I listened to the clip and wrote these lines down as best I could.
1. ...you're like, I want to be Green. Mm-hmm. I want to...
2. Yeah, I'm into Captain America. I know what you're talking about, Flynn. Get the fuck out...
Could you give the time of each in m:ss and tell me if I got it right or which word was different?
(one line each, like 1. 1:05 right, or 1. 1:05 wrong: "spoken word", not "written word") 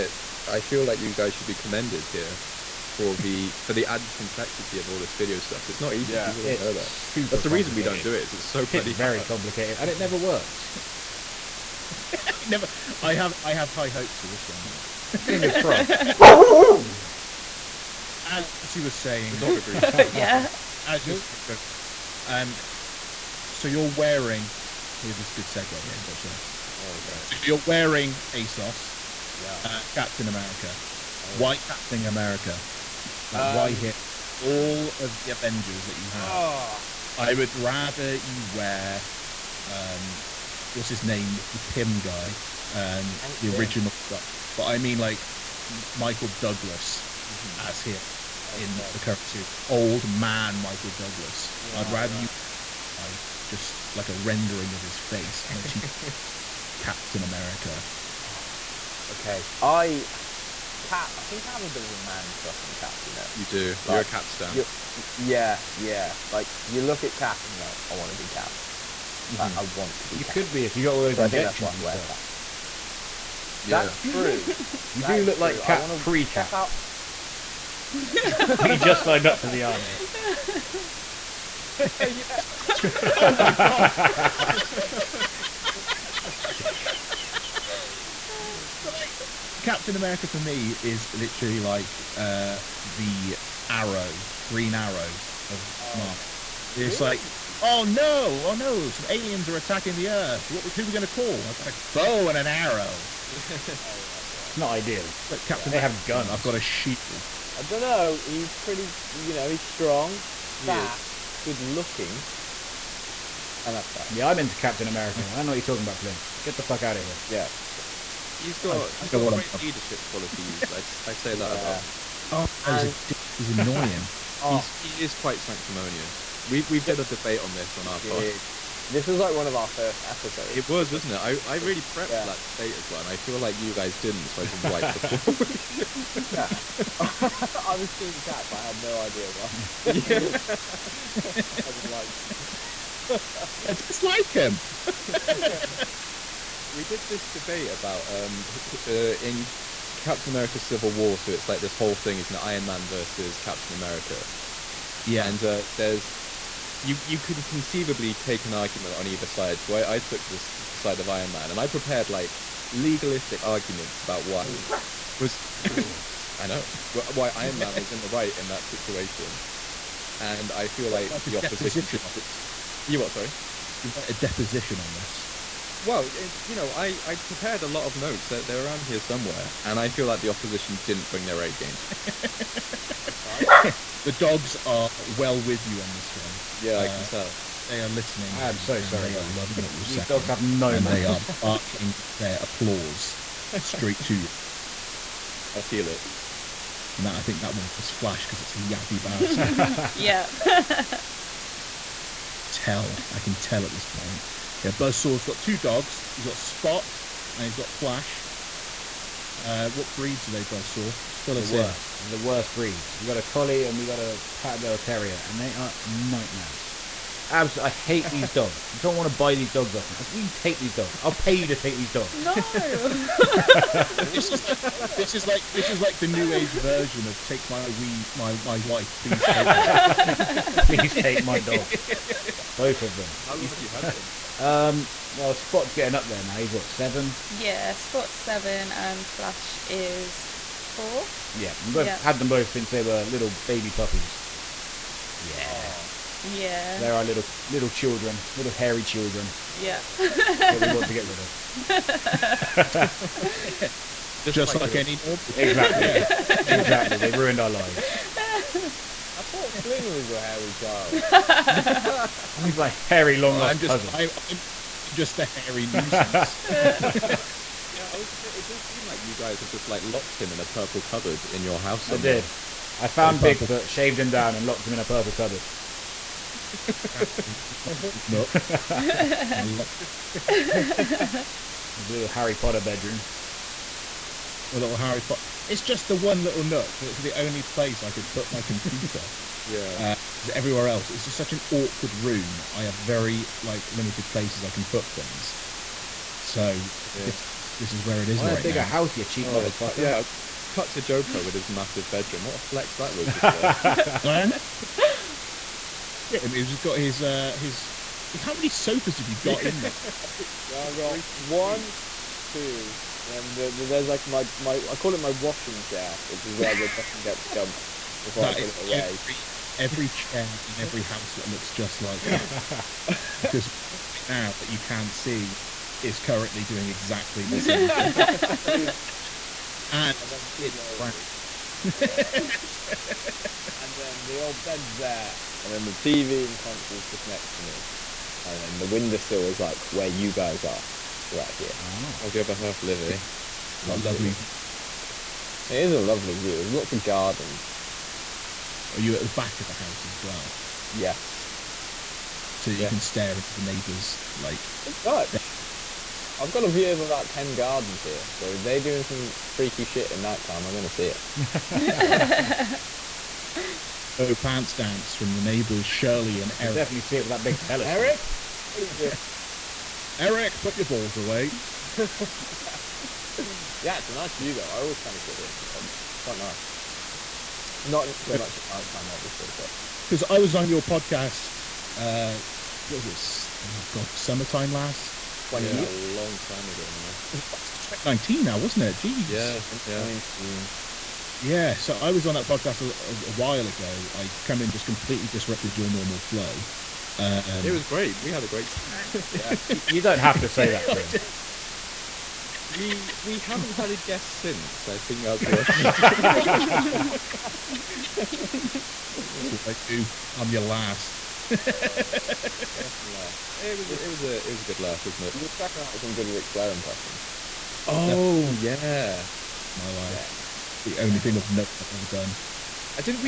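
1. 1:07 wrong: "Cap", not "Green"
2. 1:54 right.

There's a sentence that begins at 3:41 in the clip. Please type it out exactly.
I'll pay you to take these dogs.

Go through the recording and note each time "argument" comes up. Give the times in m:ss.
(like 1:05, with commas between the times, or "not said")
2:38, 2:43.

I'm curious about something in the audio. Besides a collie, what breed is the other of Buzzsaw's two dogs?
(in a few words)
Pat Terrier.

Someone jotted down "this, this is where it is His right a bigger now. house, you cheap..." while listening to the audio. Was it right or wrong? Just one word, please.
wrong.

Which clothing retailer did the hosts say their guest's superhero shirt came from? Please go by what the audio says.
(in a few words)
ASOS.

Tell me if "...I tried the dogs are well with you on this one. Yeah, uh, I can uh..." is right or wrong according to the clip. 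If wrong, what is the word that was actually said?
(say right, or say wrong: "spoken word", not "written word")
right.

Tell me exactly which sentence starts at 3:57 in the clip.
Yeah, Spot's seven, and Flash is four.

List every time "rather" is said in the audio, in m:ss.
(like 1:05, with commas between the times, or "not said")
0:37, 0:51.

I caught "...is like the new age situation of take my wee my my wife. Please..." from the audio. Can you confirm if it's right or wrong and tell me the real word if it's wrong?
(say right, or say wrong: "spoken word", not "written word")
wrong: "version", not "situation".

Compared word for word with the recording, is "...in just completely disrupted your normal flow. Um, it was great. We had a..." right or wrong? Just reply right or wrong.
right.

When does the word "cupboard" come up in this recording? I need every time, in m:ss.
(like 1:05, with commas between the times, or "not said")
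4:30, 4:35.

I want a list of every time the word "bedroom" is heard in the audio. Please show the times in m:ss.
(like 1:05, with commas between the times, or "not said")
4:42, 5:01.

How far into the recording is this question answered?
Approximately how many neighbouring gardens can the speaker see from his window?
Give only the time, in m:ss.
5:57.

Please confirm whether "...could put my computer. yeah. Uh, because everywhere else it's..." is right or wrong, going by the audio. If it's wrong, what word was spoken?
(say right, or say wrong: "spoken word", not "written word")
right.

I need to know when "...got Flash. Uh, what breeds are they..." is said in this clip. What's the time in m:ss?
3:27.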